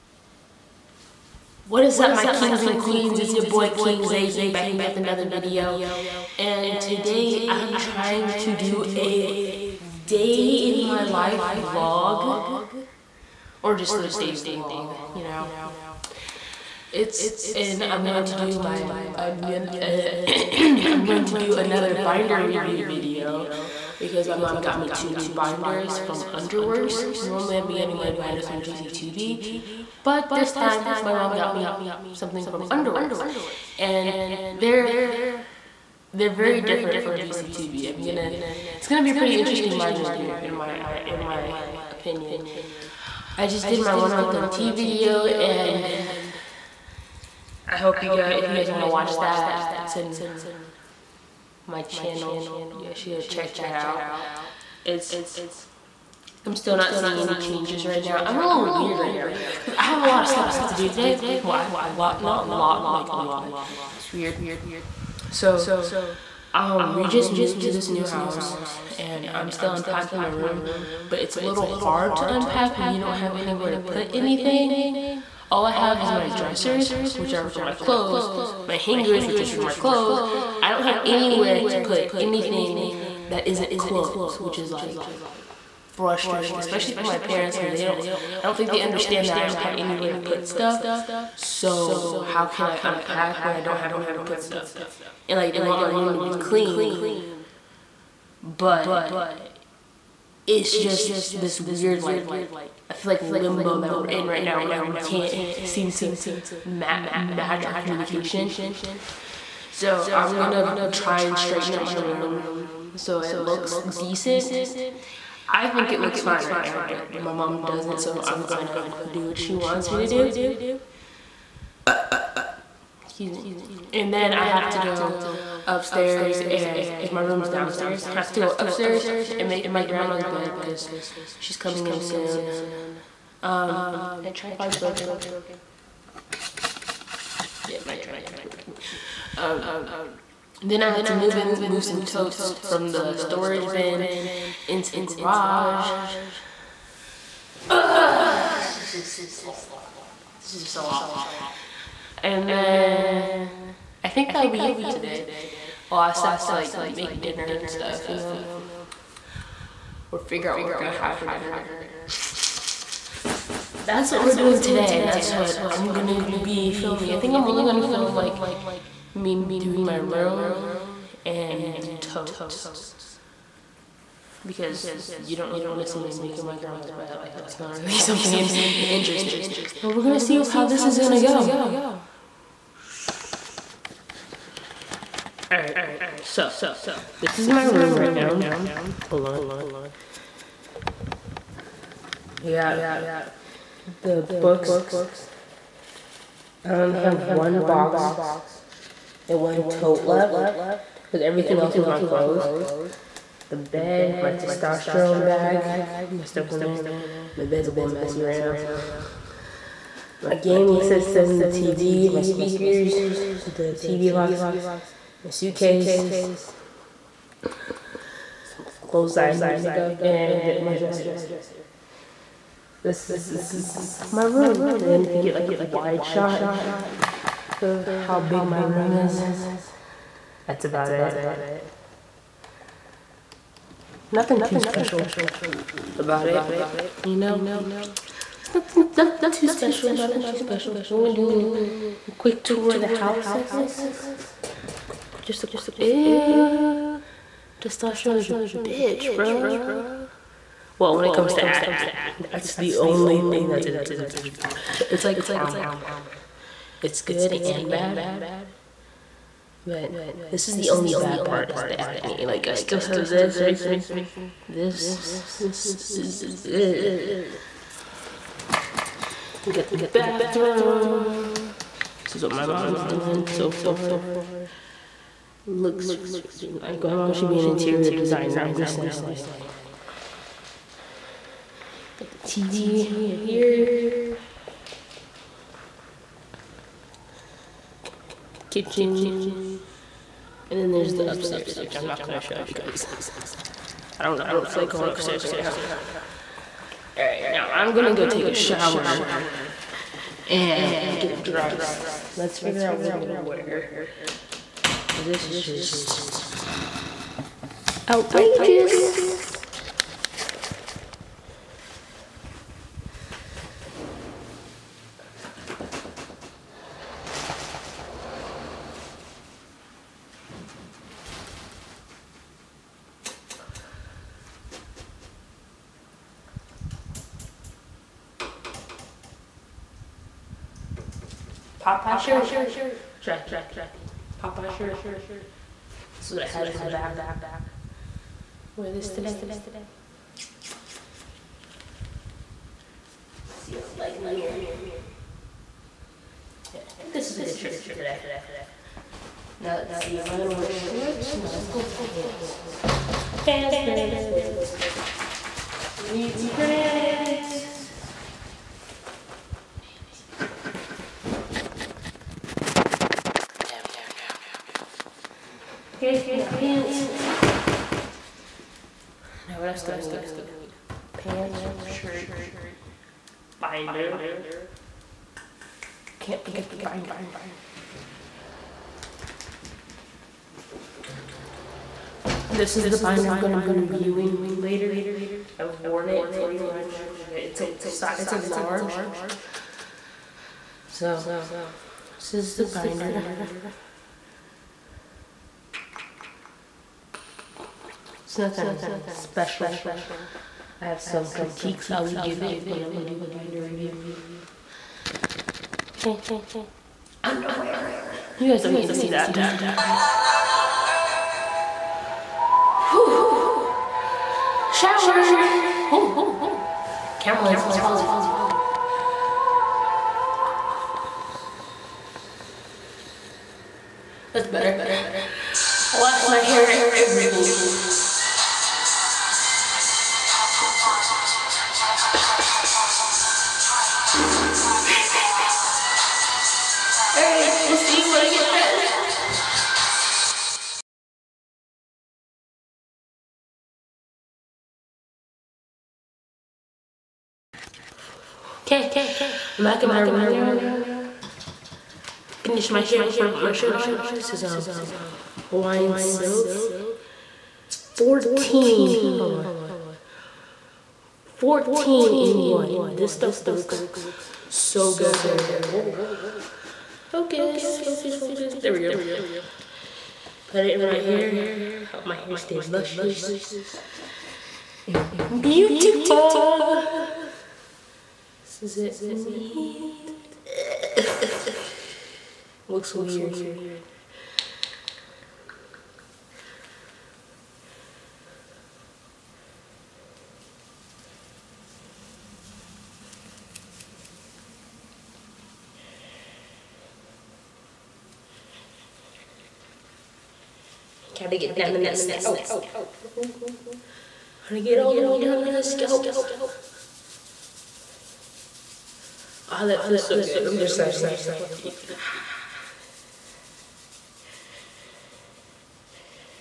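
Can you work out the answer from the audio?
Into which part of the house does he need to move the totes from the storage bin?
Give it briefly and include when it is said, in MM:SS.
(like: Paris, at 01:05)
Garage, at 02:25.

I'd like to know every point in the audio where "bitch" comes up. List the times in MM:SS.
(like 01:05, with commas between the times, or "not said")
04:08, 04:14.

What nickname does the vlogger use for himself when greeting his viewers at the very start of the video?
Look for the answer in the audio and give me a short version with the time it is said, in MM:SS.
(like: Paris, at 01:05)
King Zay, at 00:03.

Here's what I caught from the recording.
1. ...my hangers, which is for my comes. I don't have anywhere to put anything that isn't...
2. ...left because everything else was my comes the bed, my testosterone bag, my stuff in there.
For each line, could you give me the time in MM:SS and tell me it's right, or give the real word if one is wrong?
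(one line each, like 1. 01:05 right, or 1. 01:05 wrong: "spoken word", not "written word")
1. 01:18 wrong: "clothes", not "comes"
2. 03:20 wrong: "clothes", not "comes".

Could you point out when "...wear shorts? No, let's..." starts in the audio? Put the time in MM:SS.
05:50.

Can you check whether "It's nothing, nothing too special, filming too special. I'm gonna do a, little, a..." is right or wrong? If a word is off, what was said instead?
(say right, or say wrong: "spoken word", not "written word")
wrong: "nothing", not "filming".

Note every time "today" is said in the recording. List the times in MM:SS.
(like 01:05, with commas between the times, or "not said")
00:06, 01:00, 02:34, 02:44, 05:38, 05:47.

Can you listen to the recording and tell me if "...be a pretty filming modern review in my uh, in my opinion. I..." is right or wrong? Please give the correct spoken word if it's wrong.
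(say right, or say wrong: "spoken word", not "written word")
wrong: "interesting", not "filming".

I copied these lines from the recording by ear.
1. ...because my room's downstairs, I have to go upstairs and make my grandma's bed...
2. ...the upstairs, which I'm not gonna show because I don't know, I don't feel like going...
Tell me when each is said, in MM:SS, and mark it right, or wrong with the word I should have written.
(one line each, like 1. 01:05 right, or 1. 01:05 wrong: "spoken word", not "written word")
1. 02:06 right
2. 04:50 right.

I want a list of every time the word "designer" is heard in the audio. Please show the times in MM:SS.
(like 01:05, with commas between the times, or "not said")
04:37.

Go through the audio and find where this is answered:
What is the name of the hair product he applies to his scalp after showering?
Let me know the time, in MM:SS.
07:35.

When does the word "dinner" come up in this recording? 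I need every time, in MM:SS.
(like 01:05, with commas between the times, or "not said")
02:37, 02:41.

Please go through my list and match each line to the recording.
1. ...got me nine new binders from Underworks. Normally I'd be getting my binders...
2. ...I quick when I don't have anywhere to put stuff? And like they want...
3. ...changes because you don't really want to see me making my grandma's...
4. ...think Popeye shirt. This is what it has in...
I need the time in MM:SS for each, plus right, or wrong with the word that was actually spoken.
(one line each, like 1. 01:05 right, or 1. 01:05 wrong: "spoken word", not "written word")
1. 00:24 wrong: "two", not "nine"
2. 01:32 wrong: "unpack", not "quick"
3. 02:52 wrong: "totes", not "changes"
4. 05:33 right.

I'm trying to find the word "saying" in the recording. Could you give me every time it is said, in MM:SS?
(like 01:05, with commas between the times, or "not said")
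04:38, 08:30.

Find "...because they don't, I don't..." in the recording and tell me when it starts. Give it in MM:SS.
01:27.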